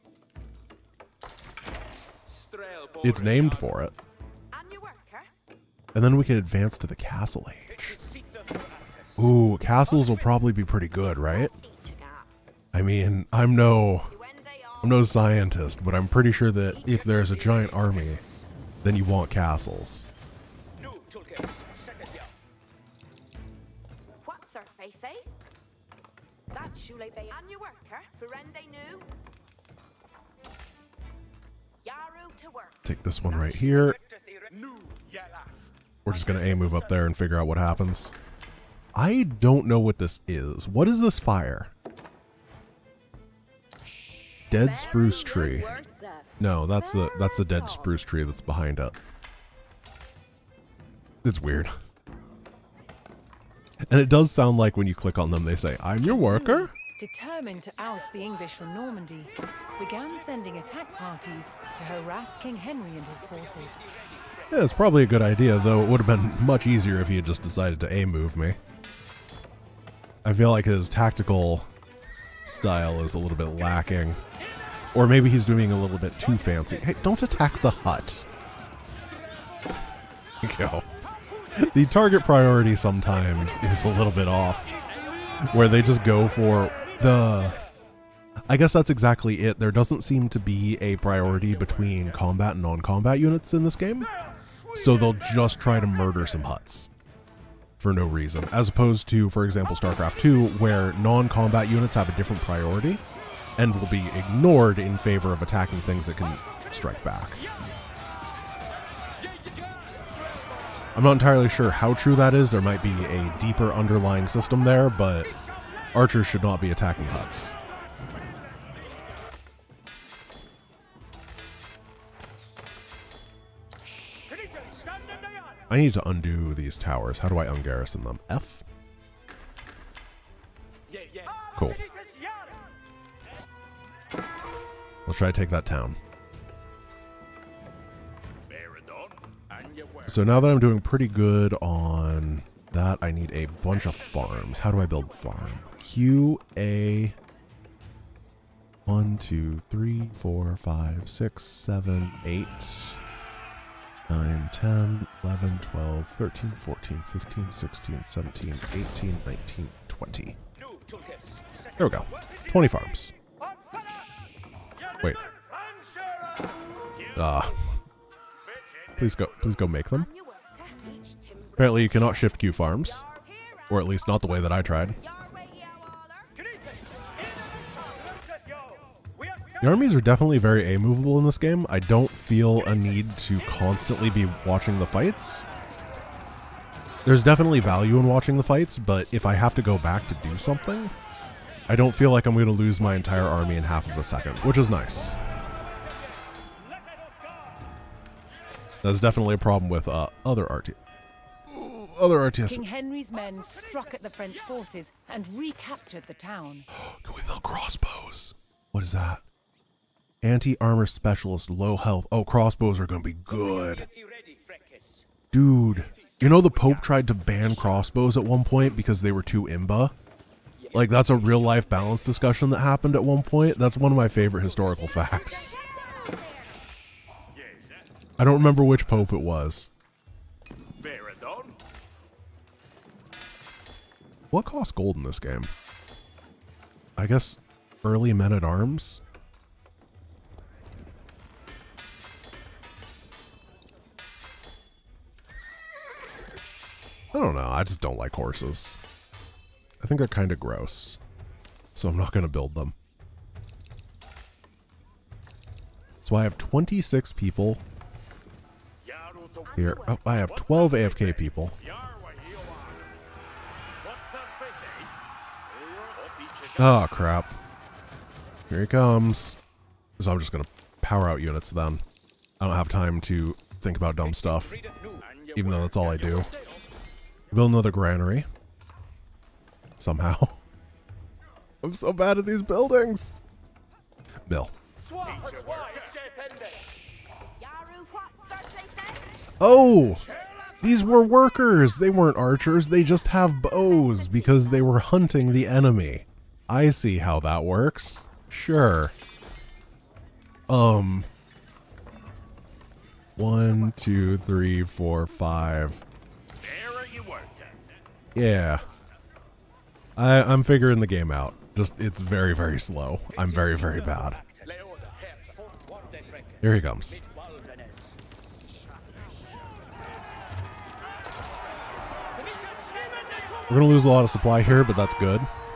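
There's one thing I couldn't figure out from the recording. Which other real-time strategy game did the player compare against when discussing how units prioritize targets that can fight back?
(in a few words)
StarCraft 2.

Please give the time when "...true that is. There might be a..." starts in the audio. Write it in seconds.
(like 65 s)
111 s.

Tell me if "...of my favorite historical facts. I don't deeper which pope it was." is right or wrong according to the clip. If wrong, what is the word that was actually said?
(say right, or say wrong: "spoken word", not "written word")
wrong: "remember", not "deeper".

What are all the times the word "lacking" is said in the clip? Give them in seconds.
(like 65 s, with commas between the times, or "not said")
73 s.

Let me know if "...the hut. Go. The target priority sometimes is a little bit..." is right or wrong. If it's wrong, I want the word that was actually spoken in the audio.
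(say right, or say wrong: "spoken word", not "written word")
right.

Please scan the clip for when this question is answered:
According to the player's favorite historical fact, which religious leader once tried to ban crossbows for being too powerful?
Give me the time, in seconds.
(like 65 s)
216 s.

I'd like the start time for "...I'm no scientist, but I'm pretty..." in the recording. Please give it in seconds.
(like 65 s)
14 s.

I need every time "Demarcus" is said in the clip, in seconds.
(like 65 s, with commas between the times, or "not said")
not said.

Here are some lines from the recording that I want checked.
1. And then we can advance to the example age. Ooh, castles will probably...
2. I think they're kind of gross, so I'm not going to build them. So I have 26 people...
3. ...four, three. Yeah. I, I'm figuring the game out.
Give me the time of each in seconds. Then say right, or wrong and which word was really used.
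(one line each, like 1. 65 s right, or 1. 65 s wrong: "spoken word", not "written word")
1. 5 s wrong: "castle", not "example"
2. 249 s right
3. 304 s wrong: "five", not "three".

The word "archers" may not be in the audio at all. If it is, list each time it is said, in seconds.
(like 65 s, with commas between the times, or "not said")
115 s, 292 s.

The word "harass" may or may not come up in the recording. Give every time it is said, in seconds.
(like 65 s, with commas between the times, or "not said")
61 s.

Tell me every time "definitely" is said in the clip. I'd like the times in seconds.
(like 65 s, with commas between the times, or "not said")
179 s, 187 s, 199 s.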